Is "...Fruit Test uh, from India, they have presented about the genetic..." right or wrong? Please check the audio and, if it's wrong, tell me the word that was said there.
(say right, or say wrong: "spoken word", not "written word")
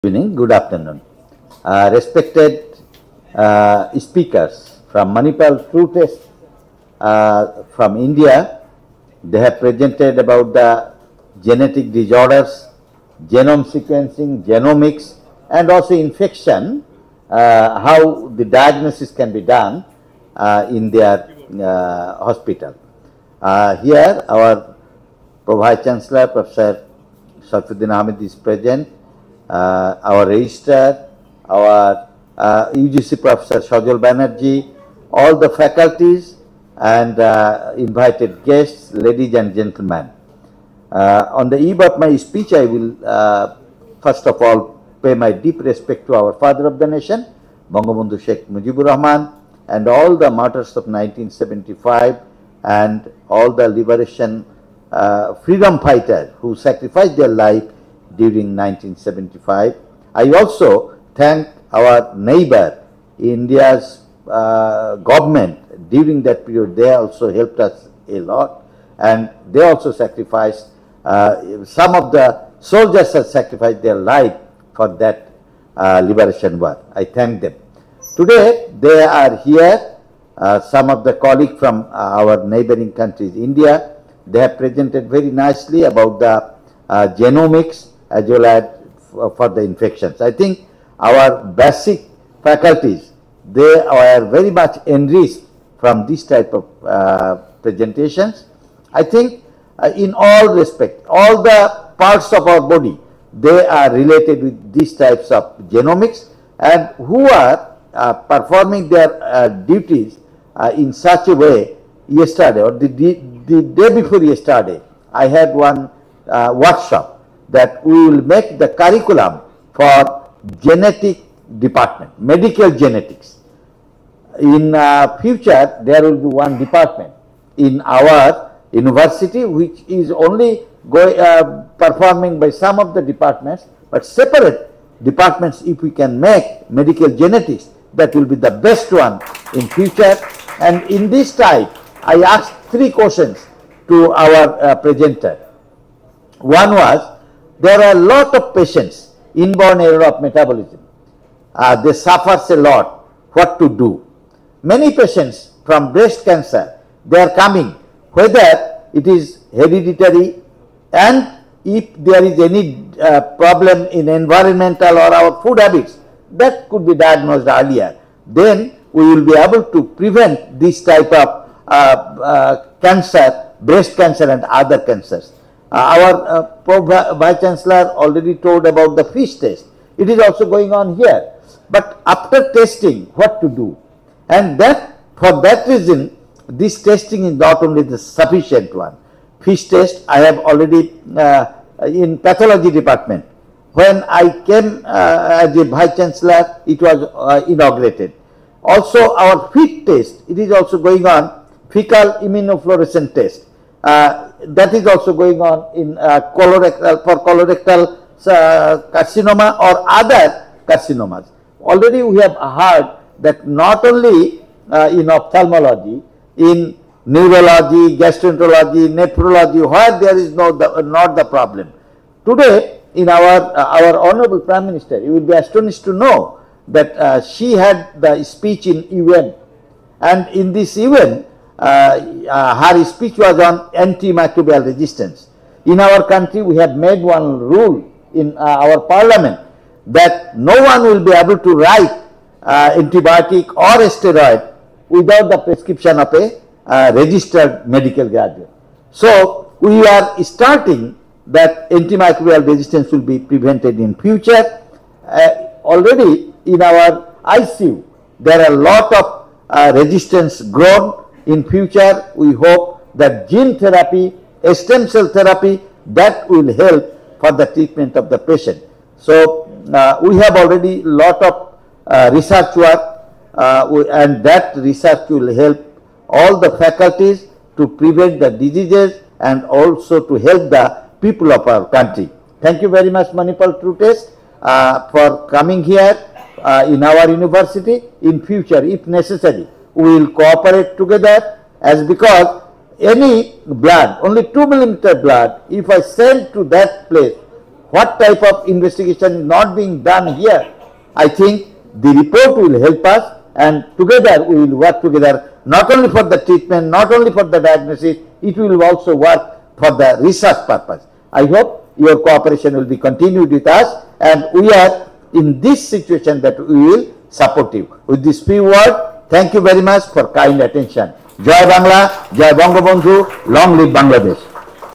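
right.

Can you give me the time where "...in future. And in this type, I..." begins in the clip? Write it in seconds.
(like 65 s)
139 s.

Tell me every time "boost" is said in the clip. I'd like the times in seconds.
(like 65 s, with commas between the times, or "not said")
not said.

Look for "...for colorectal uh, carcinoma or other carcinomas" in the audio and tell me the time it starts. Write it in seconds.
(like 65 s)
207 s.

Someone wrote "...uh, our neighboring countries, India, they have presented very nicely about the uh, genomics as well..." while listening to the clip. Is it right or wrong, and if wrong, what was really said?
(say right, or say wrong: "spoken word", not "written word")
right.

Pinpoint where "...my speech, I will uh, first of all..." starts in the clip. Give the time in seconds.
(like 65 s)
41 s.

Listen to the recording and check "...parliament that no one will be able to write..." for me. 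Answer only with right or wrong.
right.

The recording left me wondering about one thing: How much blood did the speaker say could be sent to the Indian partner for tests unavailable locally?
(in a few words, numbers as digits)
2 millimeter.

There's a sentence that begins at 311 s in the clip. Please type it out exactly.
I hope your cooperation will be continued with us and we are in this situation that we will support you.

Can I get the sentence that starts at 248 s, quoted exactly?
So we are starting that antimicrobial resistance will be prevented in future.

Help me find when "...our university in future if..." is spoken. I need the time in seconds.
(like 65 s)
286 s.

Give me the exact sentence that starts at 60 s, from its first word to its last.
I also thank our neighbor, India's uh, government during that period.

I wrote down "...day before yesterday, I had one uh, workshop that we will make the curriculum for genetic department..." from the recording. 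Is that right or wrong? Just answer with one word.
right.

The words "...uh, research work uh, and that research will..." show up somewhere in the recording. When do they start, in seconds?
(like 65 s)
271 s.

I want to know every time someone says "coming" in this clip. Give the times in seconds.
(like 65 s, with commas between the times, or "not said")
157 s, 285 s.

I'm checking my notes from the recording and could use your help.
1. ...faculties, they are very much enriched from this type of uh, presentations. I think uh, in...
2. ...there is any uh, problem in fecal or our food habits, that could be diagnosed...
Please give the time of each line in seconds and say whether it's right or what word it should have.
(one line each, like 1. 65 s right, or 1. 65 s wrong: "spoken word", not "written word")
1. 92 s right
2. 161 s wrong: "environmental", not "fecal".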